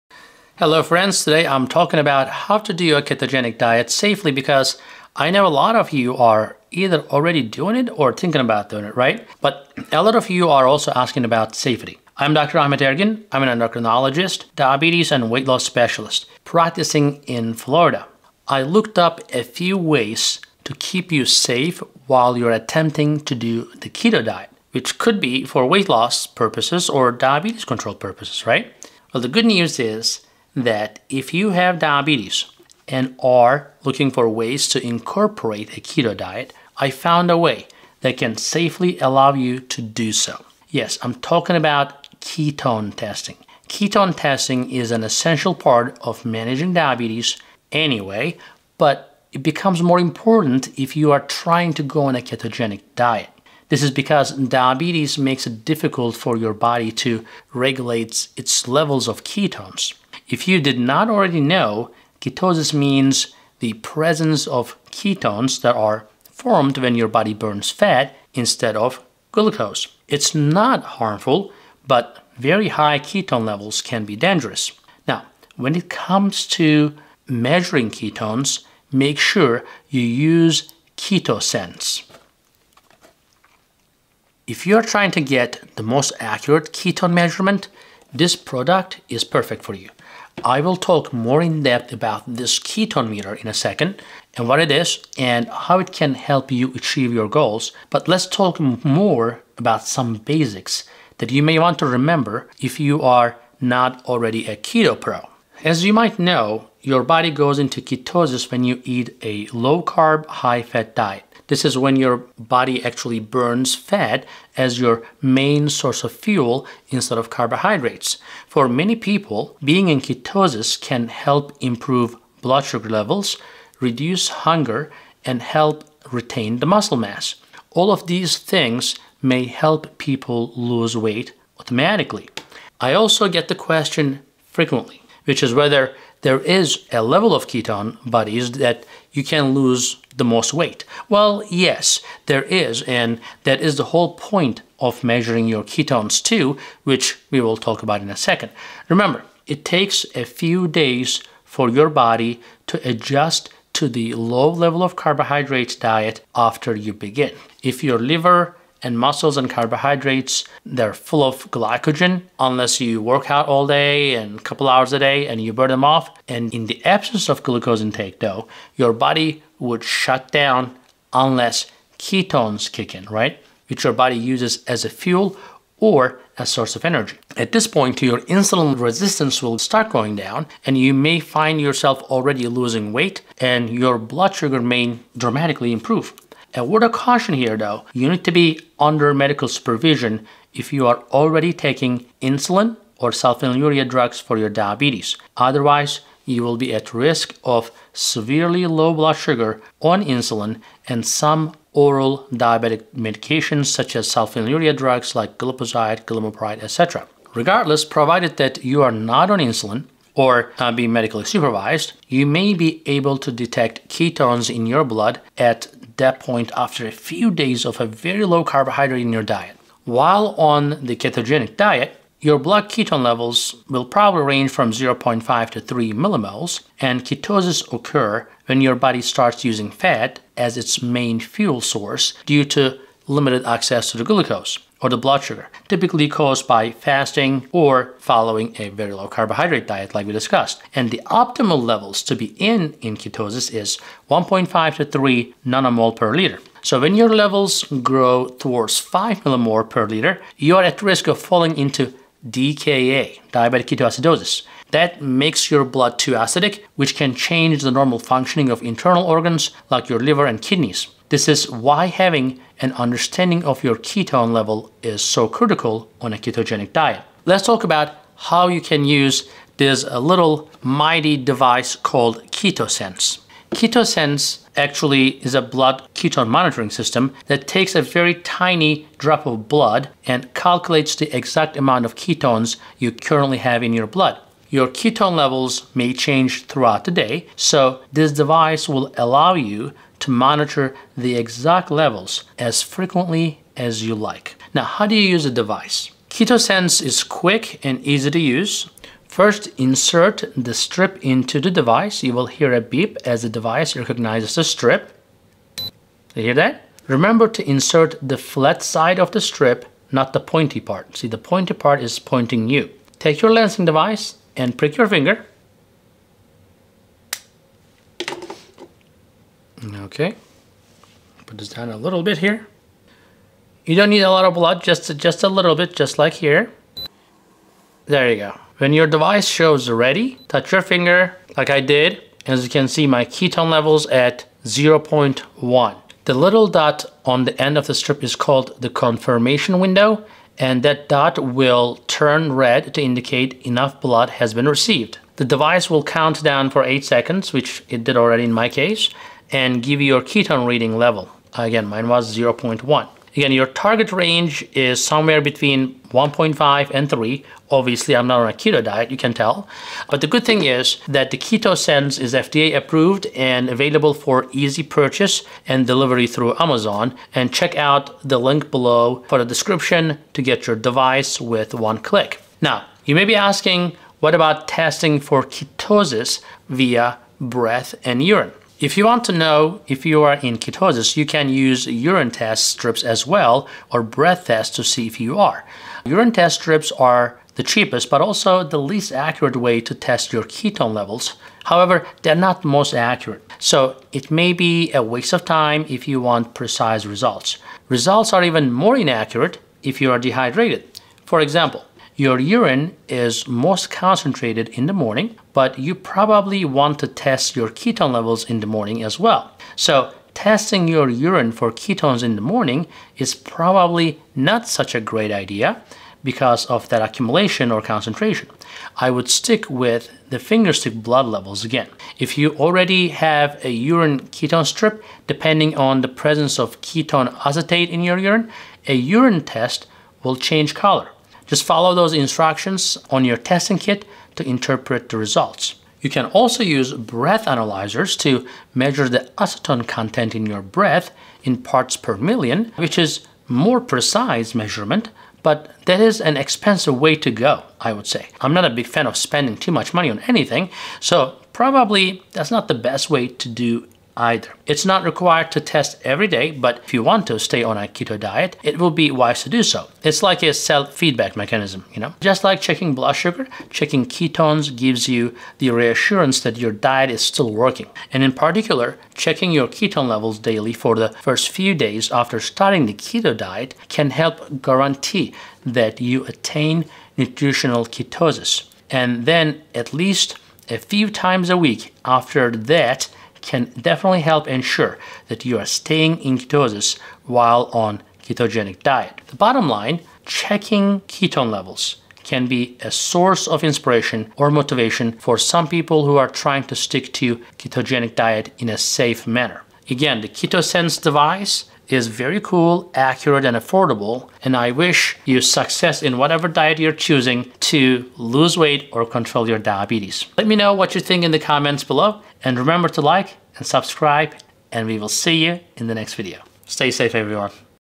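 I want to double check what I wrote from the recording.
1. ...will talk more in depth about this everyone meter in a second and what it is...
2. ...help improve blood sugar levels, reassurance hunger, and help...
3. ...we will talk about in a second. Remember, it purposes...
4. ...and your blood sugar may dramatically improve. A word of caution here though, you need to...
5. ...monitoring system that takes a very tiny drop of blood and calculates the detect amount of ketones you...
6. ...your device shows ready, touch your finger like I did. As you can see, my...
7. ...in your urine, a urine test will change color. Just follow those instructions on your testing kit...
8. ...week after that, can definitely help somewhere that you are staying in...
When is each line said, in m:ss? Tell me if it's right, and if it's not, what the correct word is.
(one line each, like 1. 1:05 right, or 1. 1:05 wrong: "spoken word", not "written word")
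1. 1:30 wrong: "ketone", not "everyone"
2. 2:01 wrong: "reduce", not "reassurance"
3. 2:27 wrong: "takes", not "purposes"
4. 3:03 right
5. 4:36 wrong: "exact", not "detect"
6. 5:28 right
7. 7:07 right
8. 8:01 wrong: "ensure", not "somewhere".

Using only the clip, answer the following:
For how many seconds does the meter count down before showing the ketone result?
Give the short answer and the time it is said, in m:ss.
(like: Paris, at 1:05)
8 seconds, at 5:46.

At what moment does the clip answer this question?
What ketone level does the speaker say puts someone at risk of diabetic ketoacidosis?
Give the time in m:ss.
4:08.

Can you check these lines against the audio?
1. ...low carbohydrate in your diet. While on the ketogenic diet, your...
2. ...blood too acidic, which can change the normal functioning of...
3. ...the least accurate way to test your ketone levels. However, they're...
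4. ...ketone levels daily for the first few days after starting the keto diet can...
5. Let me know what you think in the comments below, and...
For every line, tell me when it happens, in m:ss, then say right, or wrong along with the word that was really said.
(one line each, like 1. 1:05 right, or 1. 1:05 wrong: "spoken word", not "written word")
1. 3:38 right
2. 4:15 right
3. 6:28 right
4. 7:49 right
5. 8:30 right.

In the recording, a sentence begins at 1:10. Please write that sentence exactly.
It's not harmful, but very high ketone levels can be dangerous.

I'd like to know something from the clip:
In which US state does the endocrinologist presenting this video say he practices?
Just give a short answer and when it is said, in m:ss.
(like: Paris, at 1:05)
Florida, at 0:17.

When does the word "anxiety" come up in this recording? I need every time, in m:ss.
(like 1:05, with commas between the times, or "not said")
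not said.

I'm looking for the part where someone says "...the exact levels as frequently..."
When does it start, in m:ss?
4:50.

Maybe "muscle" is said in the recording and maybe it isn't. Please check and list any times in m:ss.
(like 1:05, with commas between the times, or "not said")
2:06, 2:38.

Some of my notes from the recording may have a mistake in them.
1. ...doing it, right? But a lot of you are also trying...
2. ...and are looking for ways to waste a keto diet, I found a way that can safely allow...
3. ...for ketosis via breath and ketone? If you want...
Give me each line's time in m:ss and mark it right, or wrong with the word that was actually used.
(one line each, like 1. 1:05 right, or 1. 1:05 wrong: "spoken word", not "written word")
1. 0:08 wrong: "asking", not "trying"
2. 0:32 wrong: "incorporate", not "waste"
3. 6:15 wrong: "urine", not "ketone".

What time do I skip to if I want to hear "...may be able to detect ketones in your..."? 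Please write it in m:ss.
3:32.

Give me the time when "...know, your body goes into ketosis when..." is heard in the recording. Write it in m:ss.
1:46.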